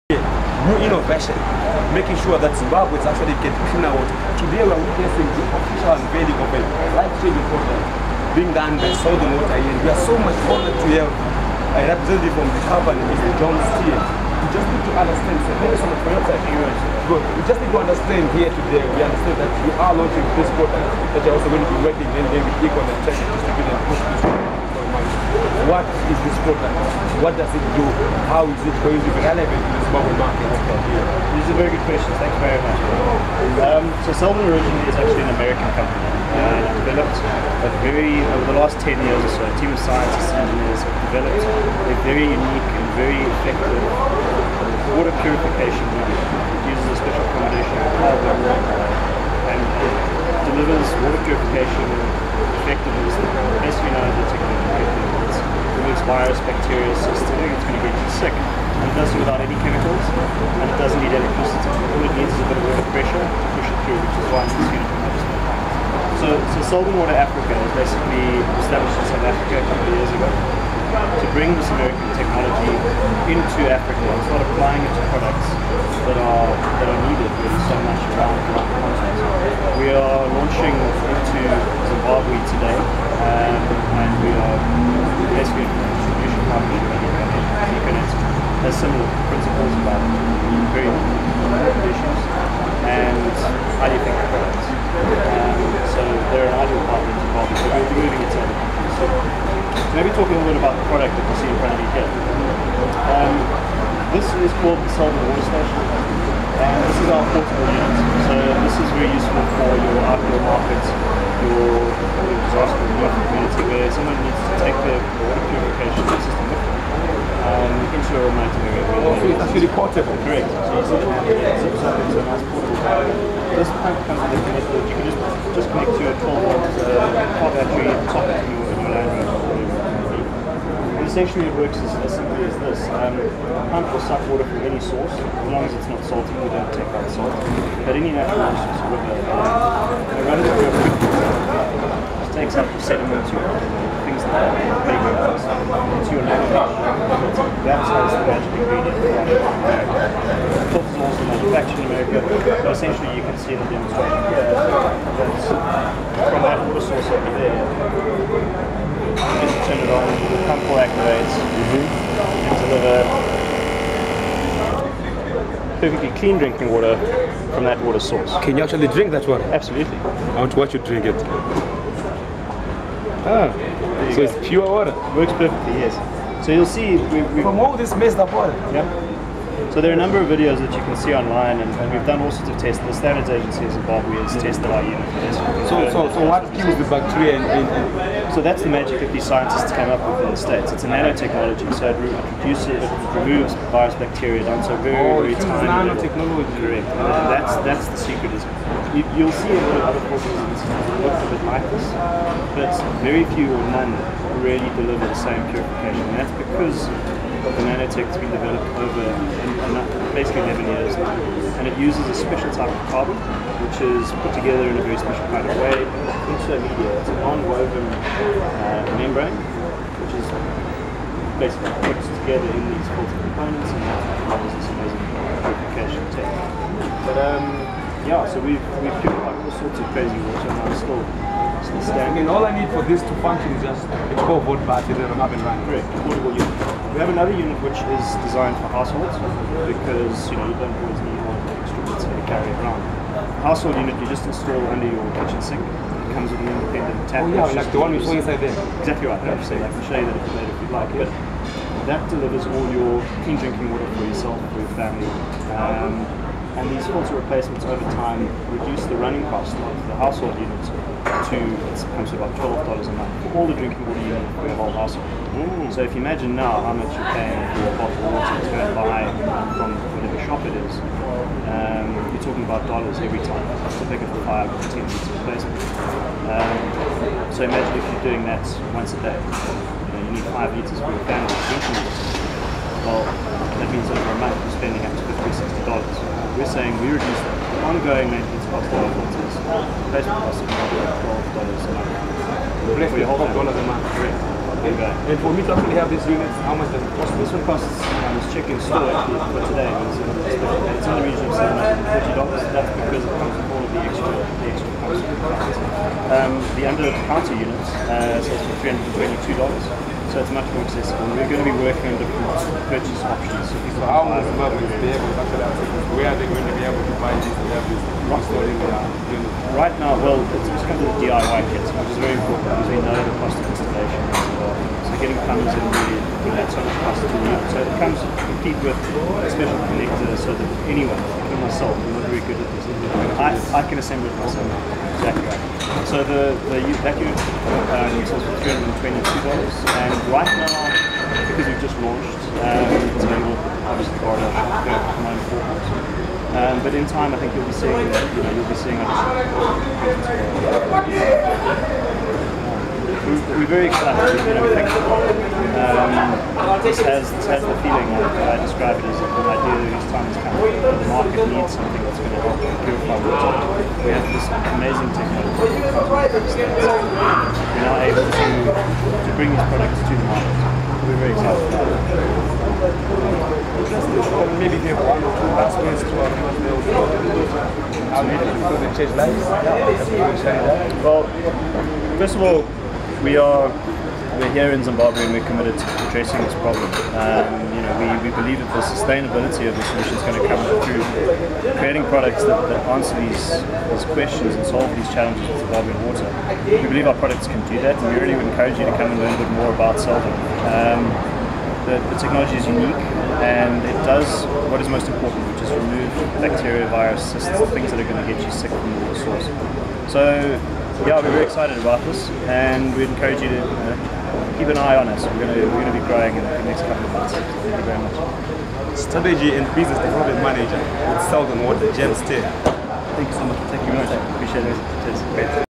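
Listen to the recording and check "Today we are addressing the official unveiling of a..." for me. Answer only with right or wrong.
wrong.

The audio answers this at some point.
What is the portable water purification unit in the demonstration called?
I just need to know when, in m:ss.
1:44.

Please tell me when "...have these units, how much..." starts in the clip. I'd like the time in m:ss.
4:55.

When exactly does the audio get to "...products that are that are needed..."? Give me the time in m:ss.
1:15.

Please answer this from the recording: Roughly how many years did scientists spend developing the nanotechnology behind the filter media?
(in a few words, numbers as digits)
11 years.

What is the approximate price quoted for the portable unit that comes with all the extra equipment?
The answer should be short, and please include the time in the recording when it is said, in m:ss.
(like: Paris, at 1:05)
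$750, at 5:01.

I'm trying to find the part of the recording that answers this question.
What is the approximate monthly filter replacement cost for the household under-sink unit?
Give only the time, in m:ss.
4:22.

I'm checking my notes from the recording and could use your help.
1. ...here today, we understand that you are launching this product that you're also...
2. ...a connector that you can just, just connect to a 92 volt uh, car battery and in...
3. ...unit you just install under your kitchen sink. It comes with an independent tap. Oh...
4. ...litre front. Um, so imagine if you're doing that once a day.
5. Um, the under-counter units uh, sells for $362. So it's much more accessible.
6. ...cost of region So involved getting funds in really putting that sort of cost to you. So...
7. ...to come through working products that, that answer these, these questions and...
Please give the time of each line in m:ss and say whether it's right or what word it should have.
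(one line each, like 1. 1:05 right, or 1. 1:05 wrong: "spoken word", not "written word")
1. 0:18 right
2. 2:04 wrong: "12", not "92"
3. 4:03 right
4. 4:34 wrong: "replacement", not "front"
5. 5:06 wrong: "322", not "362"
6. 5:23 wrong: "installation", not "region"
7. 6:30 wrong: "creating", not "working".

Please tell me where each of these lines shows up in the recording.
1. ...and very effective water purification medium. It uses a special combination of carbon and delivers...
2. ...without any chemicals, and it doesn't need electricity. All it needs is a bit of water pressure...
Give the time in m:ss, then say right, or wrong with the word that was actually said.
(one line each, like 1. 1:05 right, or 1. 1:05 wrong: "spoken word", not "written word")
1. 0:42 right
2. 0:59 right.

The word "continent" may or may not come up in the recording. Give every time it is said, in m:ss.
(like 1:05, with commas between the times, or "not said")
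1:18.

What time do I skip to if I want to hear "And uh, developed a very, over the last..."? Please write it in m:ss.
0:36.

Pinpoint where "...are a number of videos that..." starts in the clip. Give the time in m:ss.
2:59.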